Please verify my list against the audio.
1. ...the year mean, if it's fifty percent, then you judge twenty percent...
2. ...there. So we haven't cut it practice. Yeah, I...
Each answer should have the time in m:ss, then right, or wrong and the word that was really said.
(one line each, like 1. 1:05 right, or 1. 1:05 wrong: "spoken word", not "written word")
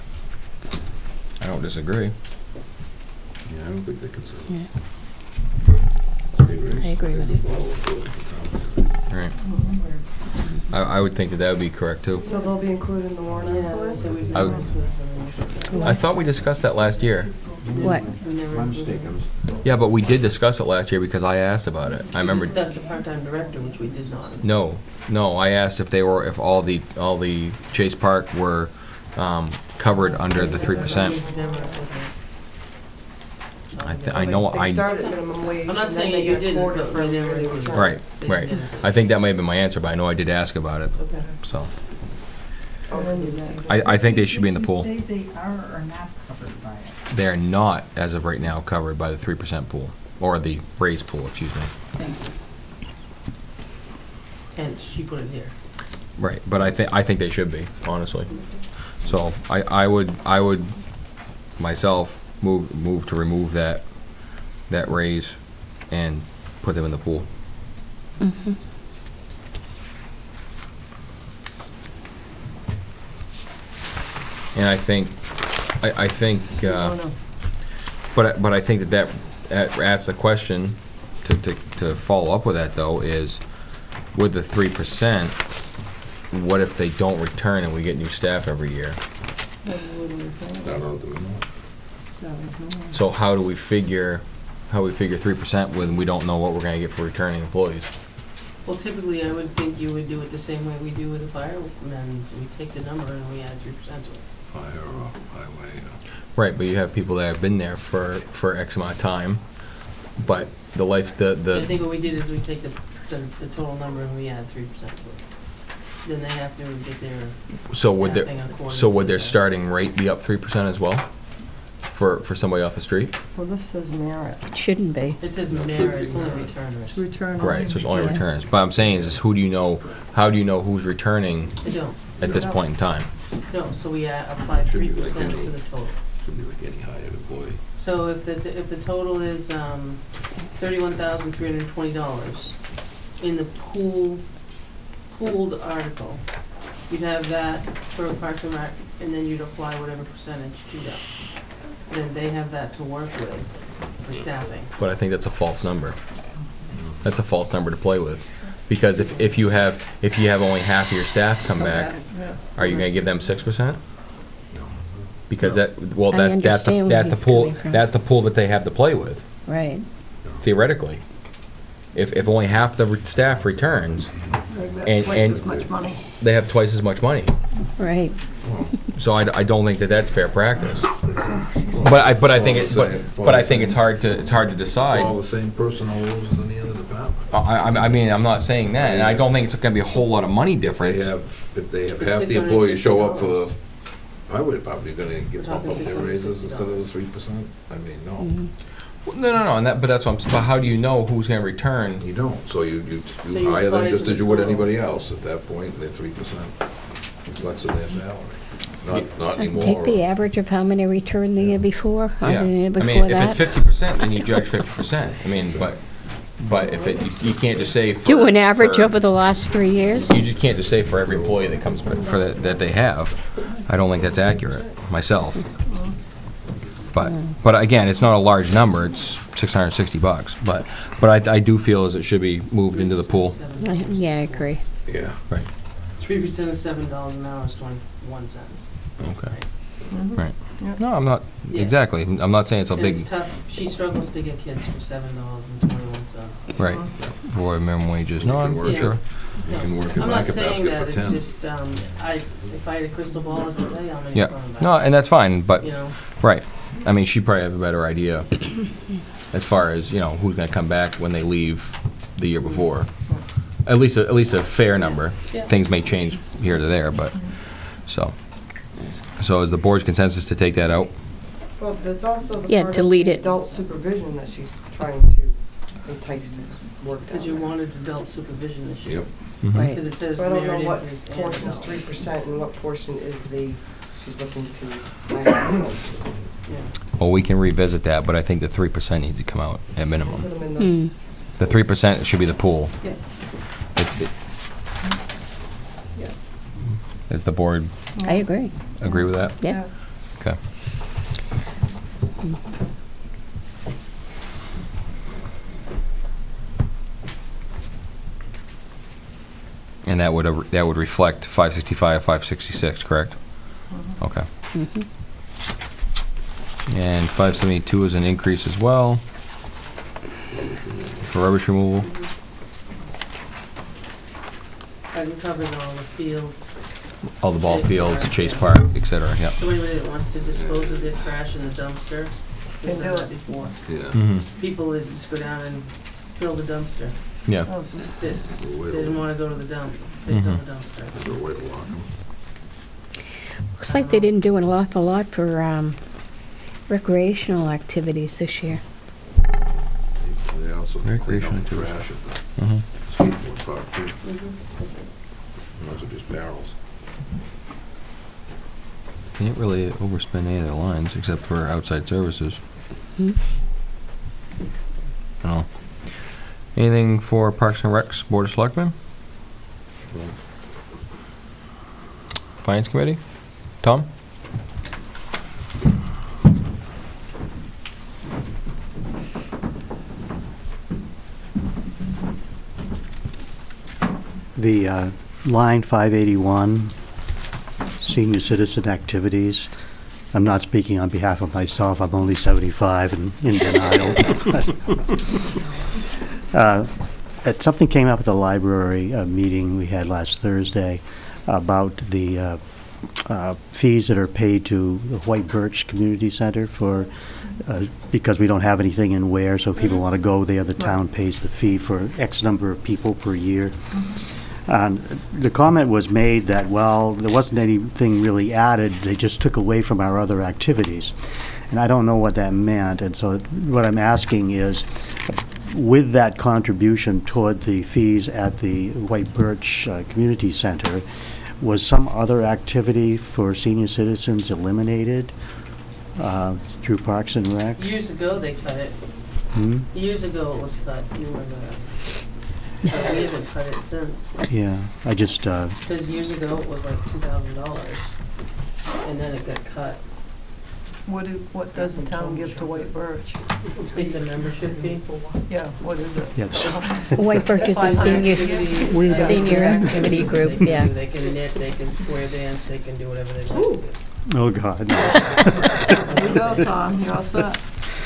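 1. 3:32 wrong: "fifty", not "twenty"
2. 7:21 wrong: "since", not "practice".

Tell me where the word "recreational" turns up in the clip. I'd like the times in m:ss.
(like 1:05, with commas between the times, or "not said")
5:46, 5:50.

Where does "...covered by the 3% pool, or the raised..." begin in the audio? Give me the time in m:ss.
0:48.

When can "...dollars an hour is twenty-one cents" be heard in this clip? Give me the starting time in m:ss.
3:56.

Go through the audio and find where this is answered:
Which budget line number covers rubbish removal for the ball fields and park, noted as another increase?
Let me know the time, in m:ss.
5:17.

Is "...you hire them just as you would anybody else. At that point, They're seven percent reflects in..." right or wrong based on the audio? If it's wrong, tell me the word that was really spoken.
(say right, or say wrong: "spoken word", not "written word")
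wrong: "three", not "seven".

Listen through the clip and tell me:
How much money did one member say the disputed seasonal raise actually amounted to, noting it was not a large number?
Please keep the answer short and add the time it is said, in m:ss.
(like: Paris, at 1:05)
660 bucks, at 3:49.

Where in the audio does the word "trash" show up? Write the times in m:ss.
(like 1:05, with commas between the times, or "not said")
5:30, 5:51.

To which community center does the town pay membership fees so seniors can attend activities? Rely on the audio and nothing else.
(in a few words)
White Birch Community Center.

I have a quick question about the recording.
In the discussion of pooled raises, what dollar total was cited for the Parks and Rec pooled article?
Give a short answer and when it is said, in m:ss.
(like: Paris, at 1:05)
$31,320, at 2:20.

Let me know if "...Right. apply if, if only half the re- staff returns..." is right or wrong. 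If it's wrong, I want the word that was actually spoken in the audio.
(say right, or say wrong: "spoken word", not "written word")
wrong: "theoretically", not "apply".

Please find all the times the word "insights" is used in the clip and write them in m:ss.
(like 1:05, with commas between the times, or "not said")
not said.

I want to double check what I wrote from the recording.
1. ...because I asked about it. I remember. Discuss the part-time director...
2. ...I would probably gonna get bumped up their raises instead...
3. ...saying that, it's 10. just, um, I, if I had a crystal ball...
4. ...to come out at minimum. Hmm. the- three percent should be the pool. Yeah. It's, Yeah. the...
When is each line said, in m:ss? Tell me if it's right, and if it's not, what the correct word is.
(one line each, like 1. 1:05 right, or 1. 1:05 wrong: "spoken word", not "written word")
1. 0:20 right
2. 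3:14 right
3. 4:10 right
4. 4:49 right.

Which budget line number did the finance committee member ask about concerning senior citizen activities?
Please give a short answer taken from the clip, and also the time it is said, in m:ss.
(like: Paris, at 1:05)
581, at 6:25.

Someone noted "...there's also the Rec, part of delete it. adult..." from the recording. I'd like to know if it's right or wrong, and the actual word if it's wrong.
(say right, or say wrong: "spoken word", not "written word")
wrong: "Yeah", not "Rec".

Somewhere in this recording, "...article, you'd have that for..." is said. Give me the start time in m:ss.
2:25.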